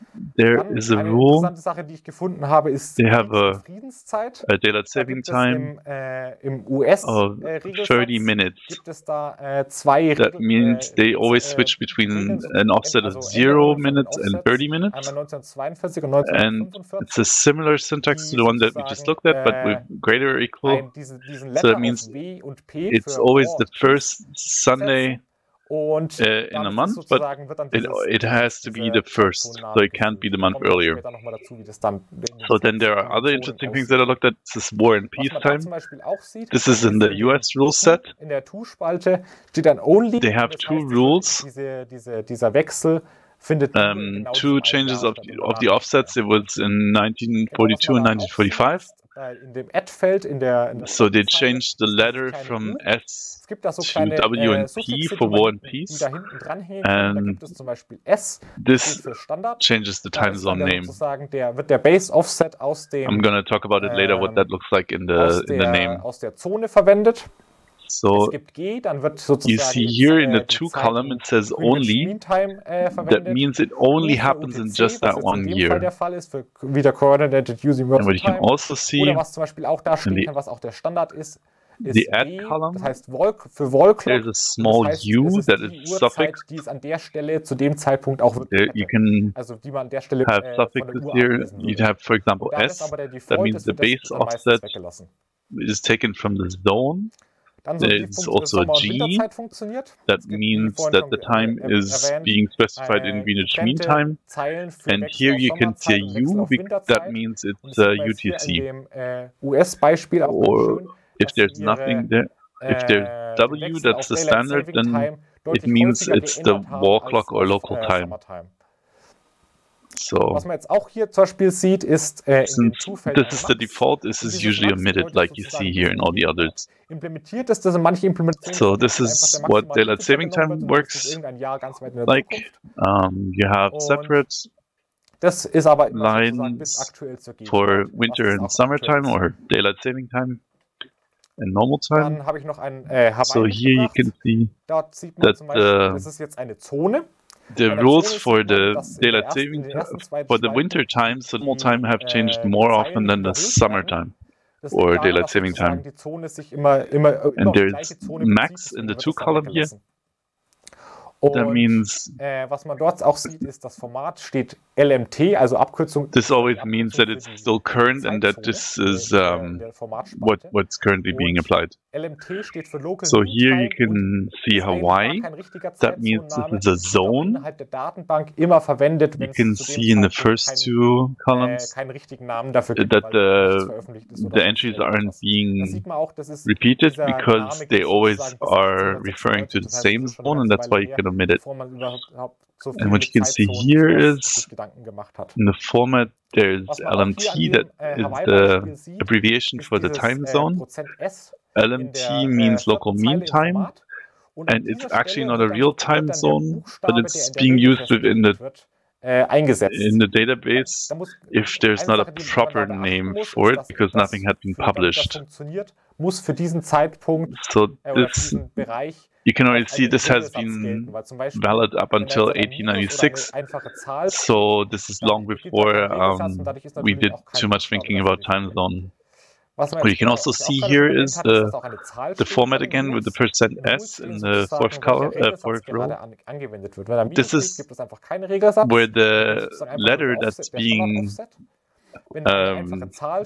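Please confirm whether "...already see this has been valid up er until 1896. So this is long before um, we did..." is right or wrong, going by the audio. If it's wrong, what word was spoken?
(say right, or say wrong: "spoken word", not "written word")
right.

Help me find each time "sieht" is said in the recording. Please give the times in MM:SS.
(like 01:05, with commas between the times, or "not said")
02:01.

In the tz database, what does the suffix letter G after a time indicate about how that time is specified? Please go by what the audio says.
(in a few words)
Greenwich Mean Time.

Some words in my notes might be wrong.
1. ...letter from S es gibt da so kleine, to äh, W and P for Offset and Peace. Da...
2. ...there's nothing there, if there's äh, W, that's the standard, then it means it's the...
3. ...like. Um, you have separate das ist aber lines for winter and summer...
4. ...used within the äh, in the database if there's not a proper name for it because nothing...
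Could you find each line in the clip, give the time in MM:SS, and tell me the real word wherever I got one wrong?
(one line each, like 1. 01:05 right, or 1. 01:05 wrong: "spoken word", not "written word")
1. 00:51 wrong: "War", not "Offset"
2. 01:51 right
3. 02:12 right
4. 03:27 right.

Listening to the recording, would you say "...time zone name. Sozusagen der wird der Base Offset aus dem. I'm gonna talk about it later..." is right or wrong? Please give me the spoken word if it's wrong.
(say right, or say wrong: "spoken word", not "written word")
right.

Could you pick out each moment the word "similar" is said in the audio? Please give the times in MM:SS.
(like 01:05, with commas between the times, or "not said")
00:17.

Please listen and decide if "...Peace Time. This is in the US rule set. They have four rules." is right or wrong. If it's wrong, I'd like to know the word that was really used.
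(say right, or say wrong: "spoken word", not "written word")
wrong: "two", not "four".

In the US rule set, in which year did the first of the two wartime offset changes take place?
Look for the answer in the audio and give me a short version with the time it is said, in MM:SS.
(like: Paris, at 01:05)
1942, at 00:46.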